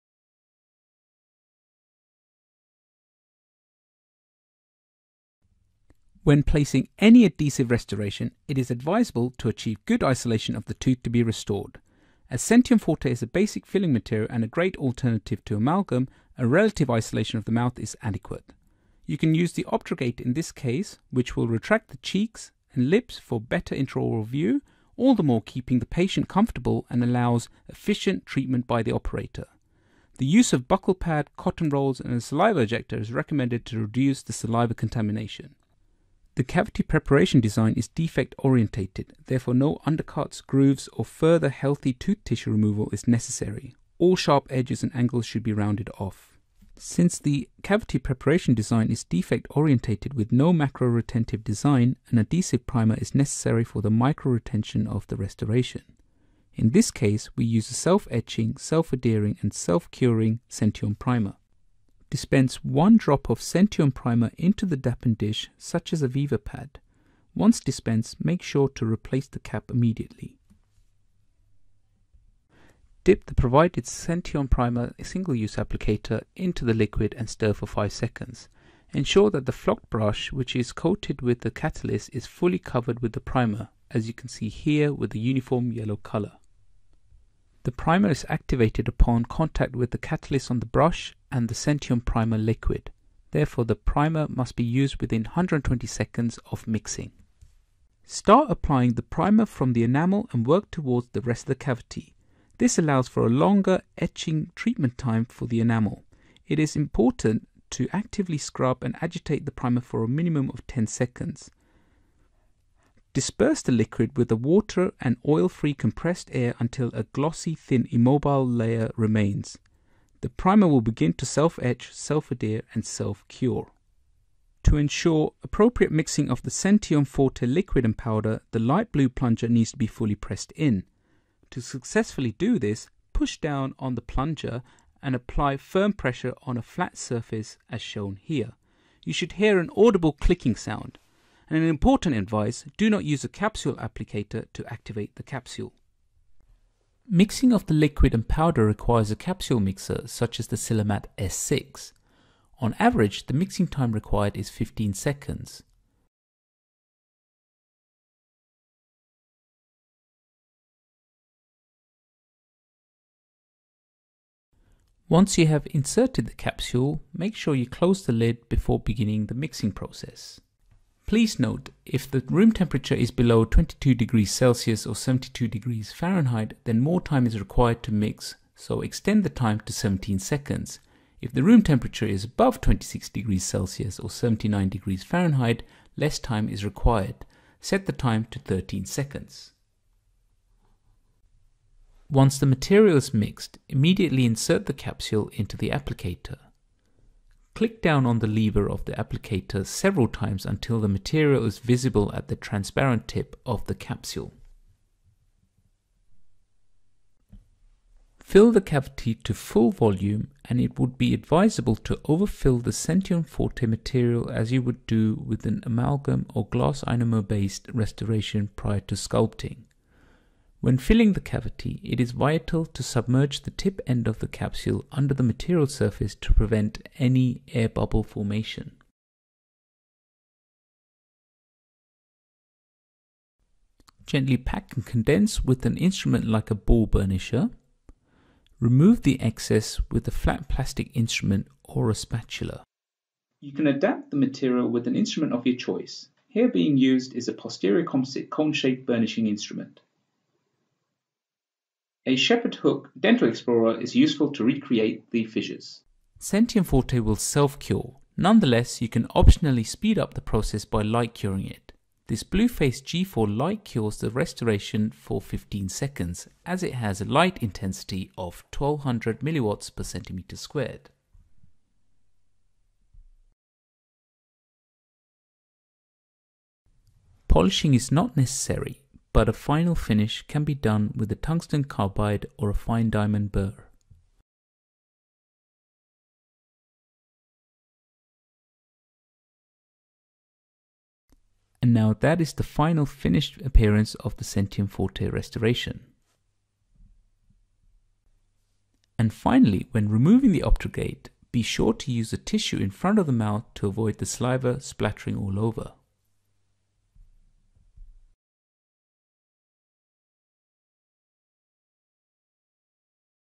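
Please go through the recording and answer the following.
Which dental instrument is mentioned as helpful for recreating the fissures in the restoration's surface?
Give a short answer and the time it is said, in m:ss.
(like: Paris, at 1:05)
shepherd hook dental explorer, at 4:12.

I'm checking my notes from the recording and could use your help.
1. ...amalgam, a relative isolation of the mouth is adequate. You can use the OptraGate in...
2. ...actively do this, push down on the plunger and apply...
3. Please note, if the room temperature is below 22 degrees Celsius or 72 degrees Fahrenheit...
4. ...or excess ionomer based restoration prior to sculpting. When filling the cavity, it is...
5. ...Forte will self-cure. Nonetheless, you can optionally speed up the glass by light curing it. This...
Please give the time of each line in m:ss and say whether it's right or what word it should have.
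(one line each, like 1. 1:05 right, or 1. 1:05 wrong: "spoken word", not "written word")
1. 0:15 right
2. 2:11 wrong: "successfully", not "actively"
3. 2:51 right
4. 3:36 wrong: "glass", not "excess"
5. 4:16 wrong: "process", not "glass".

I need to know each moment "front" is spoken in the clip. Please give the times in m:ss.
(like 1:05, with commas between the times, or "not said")
5:02.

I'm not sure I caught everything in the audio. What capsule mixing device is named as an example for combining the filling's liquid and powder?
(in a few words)
Silamat S6.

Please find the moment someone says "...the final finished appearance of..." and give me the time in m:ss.
4:52.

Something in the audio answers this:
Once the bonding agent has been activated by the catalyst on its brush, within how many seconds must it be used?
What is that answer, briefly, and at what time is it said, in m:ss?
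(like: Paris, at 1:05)
120 seconds, at 1:35.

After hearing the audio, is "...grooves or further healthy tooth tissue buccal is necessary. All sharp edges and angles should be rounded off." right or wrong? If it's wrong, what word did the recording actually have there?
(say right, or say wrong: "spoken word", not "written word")
wrong: "removal", not "buccal".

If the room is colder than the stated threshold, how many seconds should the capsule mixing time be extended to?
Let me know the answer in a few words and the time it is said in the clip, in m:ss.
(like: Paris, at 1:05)
17 seconds, at 2:59.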